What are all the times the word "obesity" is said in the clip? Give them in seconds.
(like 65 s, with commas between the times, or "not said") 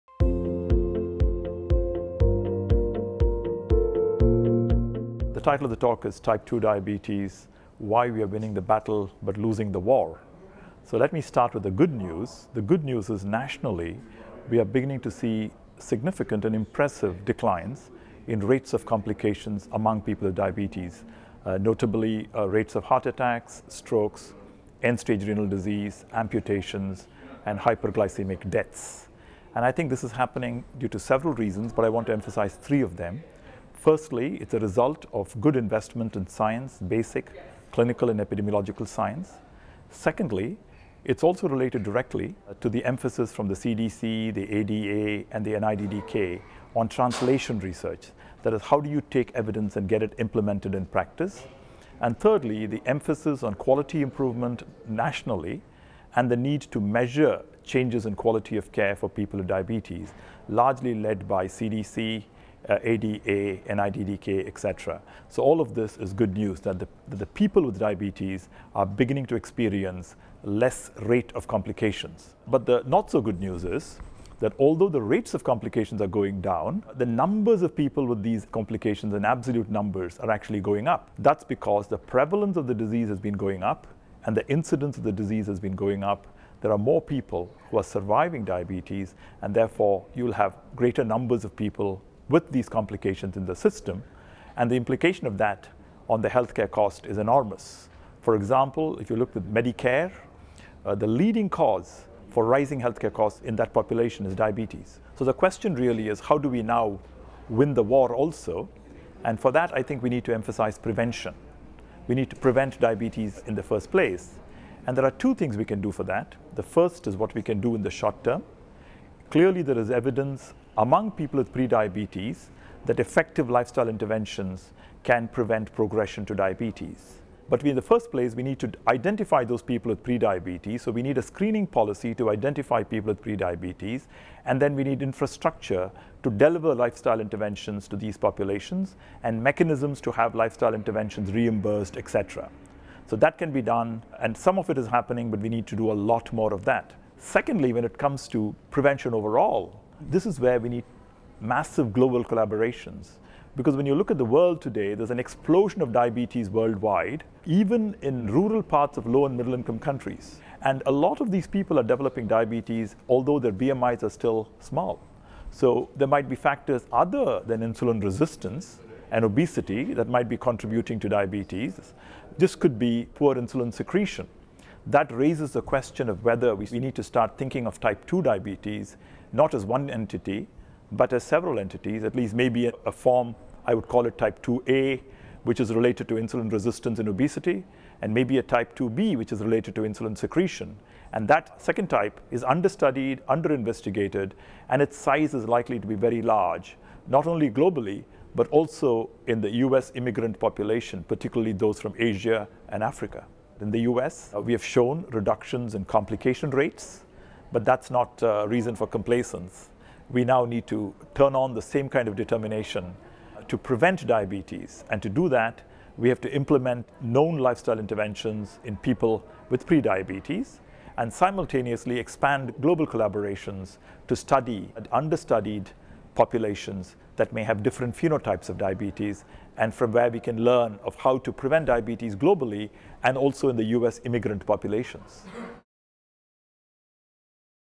169 s, 187 s.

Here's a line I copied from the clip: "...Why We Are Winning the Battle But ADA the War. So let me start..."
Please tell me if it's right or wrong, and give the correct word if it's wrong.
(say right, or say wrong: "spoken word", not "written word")
wrong: "Losing", not "ADA".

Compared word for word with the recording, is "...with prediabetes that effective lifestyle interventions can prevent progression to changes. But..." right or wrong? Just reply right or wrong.
wrong.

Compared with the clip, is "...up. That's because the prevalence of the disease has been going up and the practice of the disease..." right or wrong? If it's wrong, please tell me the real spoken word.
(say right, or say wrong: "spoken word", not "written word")
wrong: "incidence", not "practice".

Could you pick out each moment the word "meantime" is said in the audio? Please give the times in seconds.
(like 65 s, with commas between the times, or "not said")
not said.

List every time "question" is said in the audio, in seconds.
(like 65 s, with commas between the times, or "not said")
105 s, 175 s.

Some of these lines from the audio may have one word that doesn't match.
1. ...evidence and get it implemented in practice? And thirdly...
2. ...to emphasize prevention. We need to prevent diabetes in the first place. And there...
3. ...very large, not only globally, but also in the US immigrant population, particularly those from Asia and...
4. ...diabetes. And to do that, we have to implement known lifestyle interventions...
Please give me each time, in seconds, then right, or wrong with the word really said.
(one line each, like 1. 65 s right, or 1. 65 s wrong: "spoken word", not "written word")
1. 49 s right
2. 110 s right
3. 195 s right
4. 214 s right.